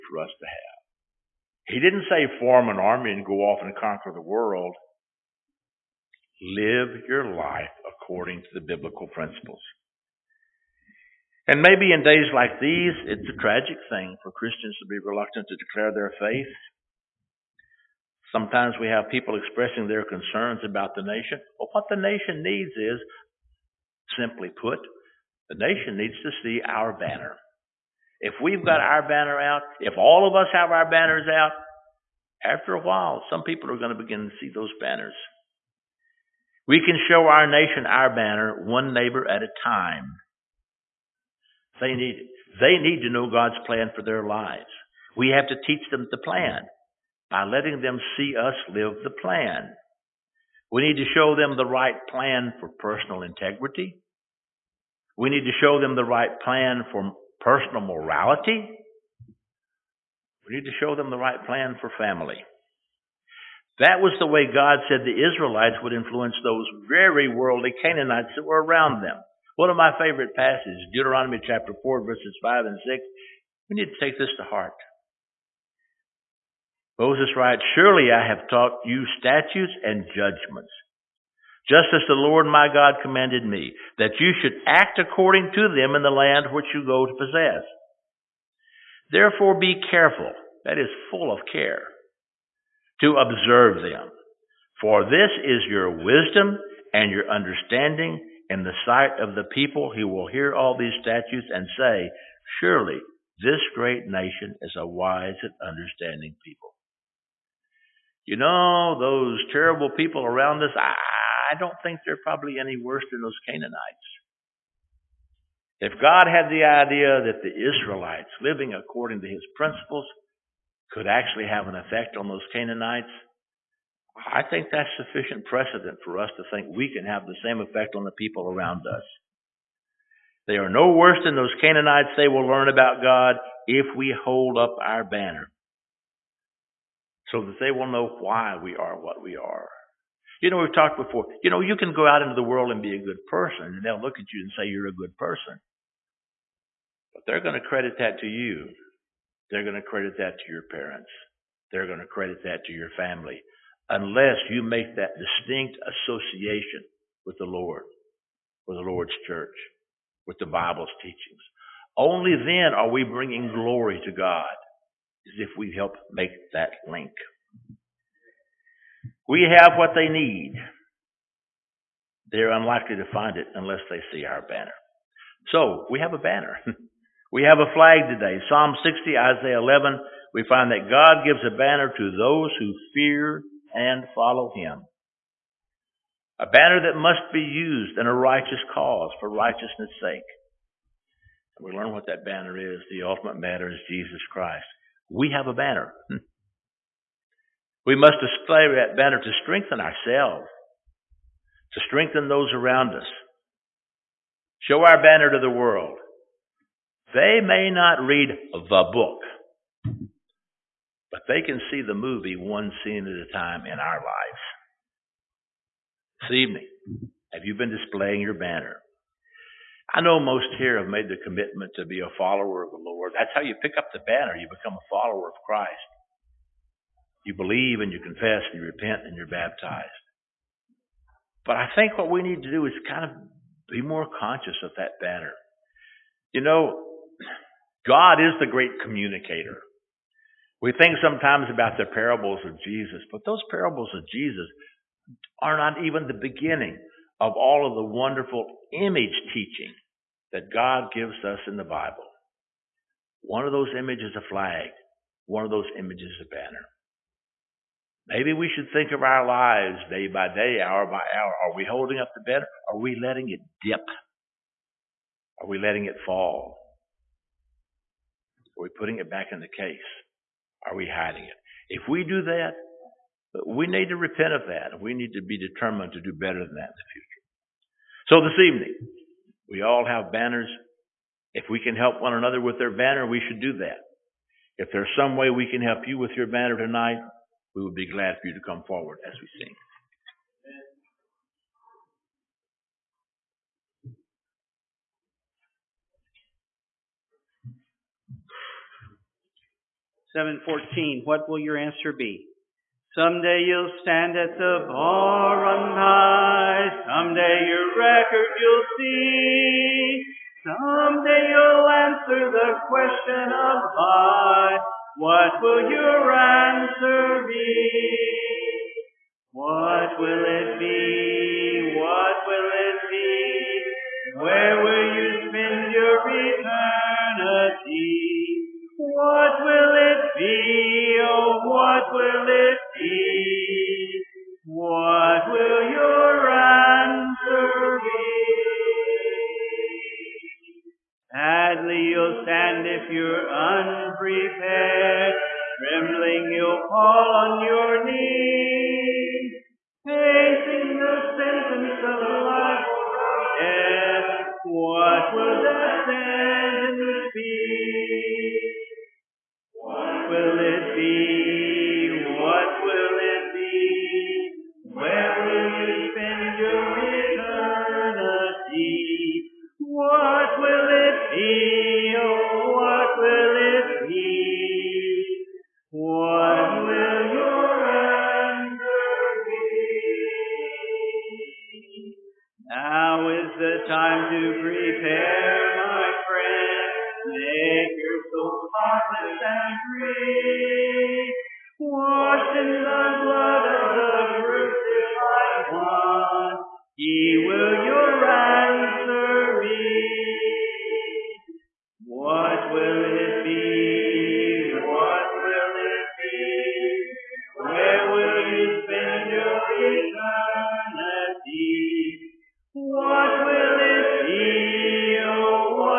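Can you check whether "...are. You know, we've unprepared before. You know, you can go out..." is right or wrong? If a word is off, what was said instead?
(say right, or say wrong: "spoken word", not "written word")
wrong: "talked", not "unprepared".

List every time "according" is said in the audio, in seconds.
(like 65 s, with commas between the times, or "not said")
7 s, 84 s, 118 s.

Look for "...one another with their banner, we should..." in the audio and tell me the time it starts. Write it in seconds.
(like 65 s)
282 s.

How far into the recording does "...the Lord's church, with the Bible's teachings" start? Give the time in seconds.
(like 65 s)
158 s.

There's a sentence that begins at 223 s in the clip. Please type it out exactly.
That's how you pick up the banner.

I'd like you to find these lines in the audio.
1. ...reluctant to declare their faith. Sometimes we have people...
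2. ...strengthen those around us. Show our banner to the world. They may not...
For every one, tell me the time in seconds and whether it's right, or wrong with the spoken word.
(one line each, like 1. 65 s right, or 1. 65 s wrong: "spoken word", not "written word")
1. 15 s right
2. 201 s right.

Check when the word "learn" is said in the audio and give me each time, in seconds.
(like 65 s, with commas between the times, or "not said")
132 s, 191 s.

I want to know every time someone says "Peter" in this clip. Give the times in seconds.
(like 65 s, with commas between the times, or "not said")
not said.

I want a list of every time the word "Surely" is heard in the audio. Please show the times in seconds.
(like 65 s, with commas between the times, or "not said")
77 s, 102 s.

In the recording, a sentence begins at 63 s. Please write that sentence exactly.
That was the way God said the Israelites would influence those very worldly Canaanites that were around them.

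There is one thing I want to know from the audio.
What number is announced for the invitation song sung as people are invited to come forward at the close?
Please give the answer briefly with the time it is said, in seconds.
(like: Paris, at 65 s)
714, at 300 s.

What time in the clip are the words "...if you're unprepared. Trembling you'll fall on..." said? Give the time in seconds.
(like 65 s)
342 s.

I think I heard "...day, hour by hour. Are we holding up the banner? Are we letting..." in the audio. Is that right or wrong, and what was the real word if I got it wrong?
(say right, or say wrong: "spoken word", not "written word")
right.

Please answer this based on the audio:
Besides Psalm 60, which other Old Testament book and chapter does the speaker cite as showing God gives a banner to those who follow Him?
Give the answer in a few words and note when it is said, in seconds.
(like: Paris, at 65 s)
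Isaiah 11, at 179 s.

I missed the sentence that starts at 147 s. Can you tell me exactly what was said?
But they're going to credit that to you they're going to credit that to your parents.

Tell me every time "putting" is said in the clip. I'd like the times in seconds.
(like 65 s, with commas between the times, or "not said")
268 s.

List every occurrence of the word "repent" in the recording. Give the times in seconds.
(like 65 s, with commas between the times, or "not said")
228 s, 273 s.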